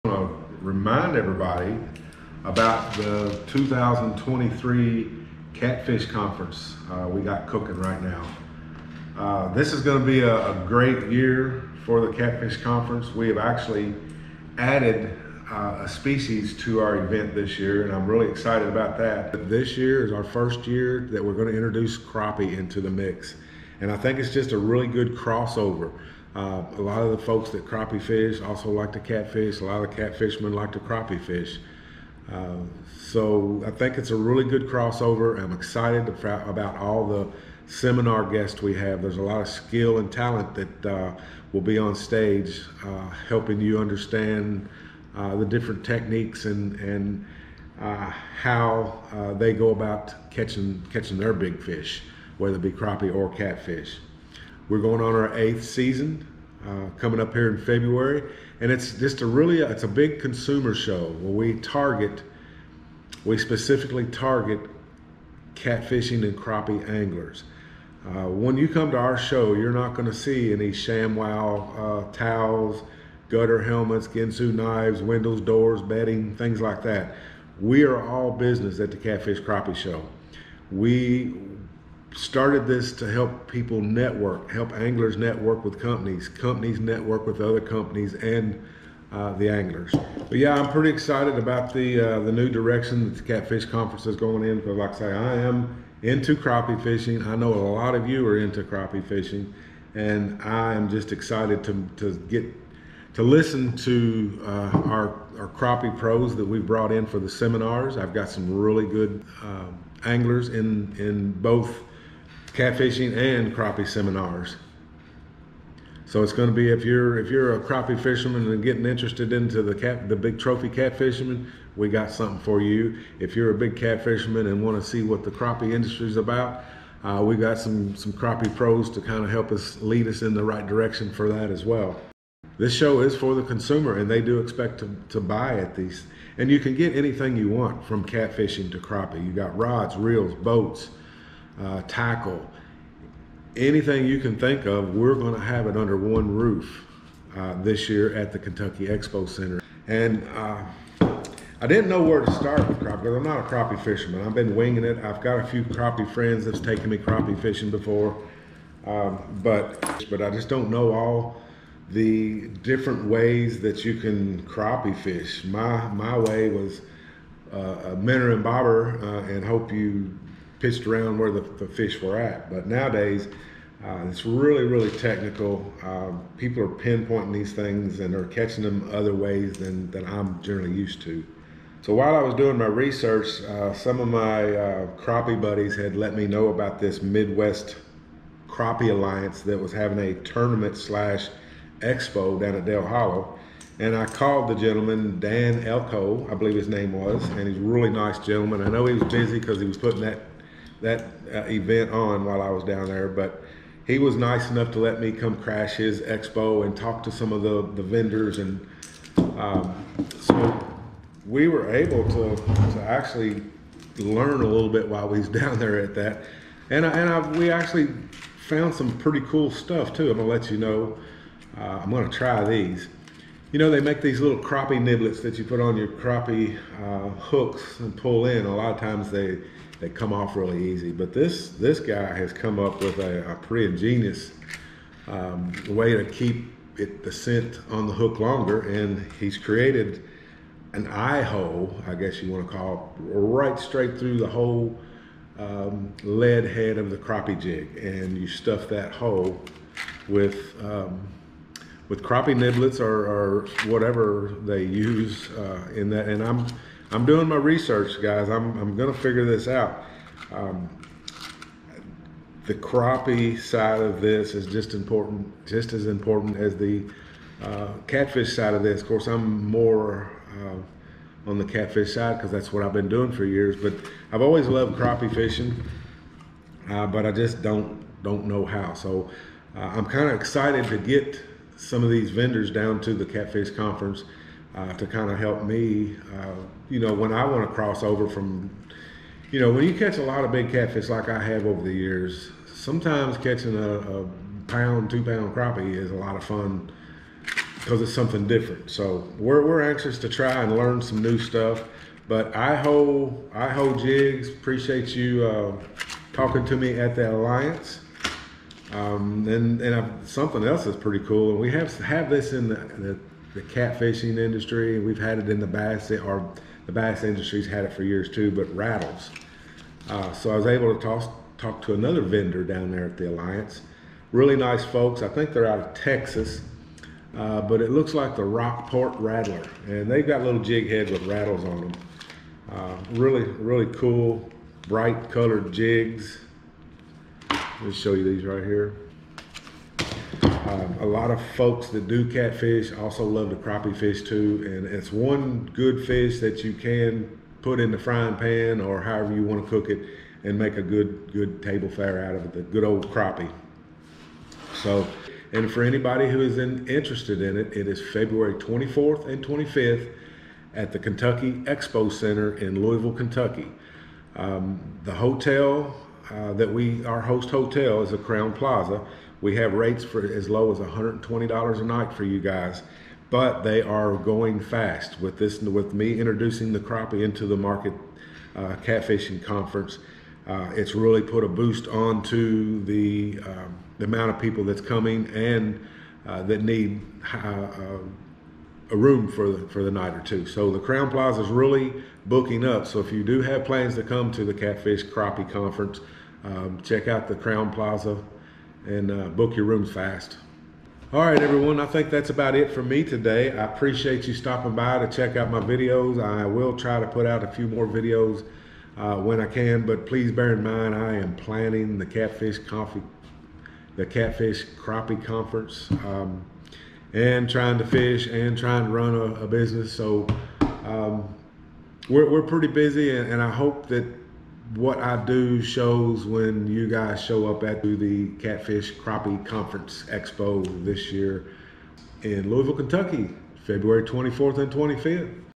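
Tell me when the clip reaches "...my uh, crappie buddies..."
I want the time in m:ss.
3:04.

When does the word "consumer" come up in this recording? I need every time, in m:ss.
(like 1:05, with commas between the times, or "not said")
1:00, 2:13.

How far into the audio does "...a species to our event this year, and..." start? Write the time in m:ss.
0:15.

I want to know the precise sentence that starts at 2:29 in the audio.
And uh, I didn't know where to start with crappie because I'm not a crappie fisherman.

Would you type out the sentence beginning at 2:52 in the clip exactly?
But nowadays, uh, it's really, really technical.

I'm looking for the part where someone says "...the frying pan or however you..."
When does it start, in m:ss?
5:47.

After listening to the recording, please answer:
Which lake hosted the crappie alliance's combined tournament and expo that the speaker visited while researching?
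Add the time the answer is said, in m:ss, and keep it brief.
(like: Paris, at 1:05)
Dale Hollow, at 3:12.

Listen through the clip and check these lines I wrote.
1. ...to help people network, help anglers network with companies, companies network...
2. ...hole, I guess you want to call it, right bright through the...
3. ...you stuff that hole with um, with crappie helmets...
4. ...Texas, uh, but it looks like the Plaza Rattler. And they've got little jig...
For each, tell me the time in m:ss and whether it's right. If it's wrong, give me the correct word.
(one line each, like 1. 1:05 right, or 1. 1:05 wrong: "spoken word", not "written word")
1. 1:22 right
2. 4:01 wrong: "straight", not "bright"
3. 4:08 wrong: "niblets", not "helmets"
4. 5:25 wrong: "Rockport", not "Plaza".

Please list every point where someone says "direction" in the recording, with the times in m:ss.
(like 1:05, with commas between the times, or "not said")
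1:32, 2:10.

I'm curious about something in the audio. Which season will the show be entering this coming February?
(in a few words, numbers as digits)
eighth.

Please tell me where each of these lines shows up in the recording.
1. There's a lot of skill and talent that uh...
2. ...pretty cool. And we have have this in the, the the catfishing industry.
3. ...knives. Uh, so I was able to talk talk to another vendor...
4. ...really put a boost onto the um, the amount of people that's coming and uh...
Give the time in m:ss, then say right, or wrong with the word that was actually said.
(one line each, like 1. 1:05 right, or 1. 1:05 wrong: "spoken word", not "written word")
1. 0:39 right
2. 5:10 right
3. 5:18 wrong: "rattles", not "knives"
4. 6:20 right.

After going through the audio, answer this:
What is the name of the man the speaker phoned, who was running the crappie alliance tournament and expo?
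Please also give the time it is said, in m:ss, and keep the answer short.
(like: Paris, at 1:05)
Dan Elko, at 3:15.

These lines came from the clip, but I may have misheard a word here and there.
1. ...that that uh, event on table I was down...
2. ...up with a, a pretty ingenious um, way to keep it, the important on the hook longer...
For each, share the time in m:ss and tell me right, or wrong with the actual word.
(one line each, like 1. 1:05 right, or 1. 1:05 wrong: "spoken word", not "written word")
1. 3:20 wrong: "while", not "table"
2. 3:52 wrong: "scent", not "important".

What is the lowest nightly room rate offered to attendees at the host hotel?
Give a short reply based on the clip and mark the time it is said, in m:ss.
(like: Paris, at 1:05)
$120, at 6:10.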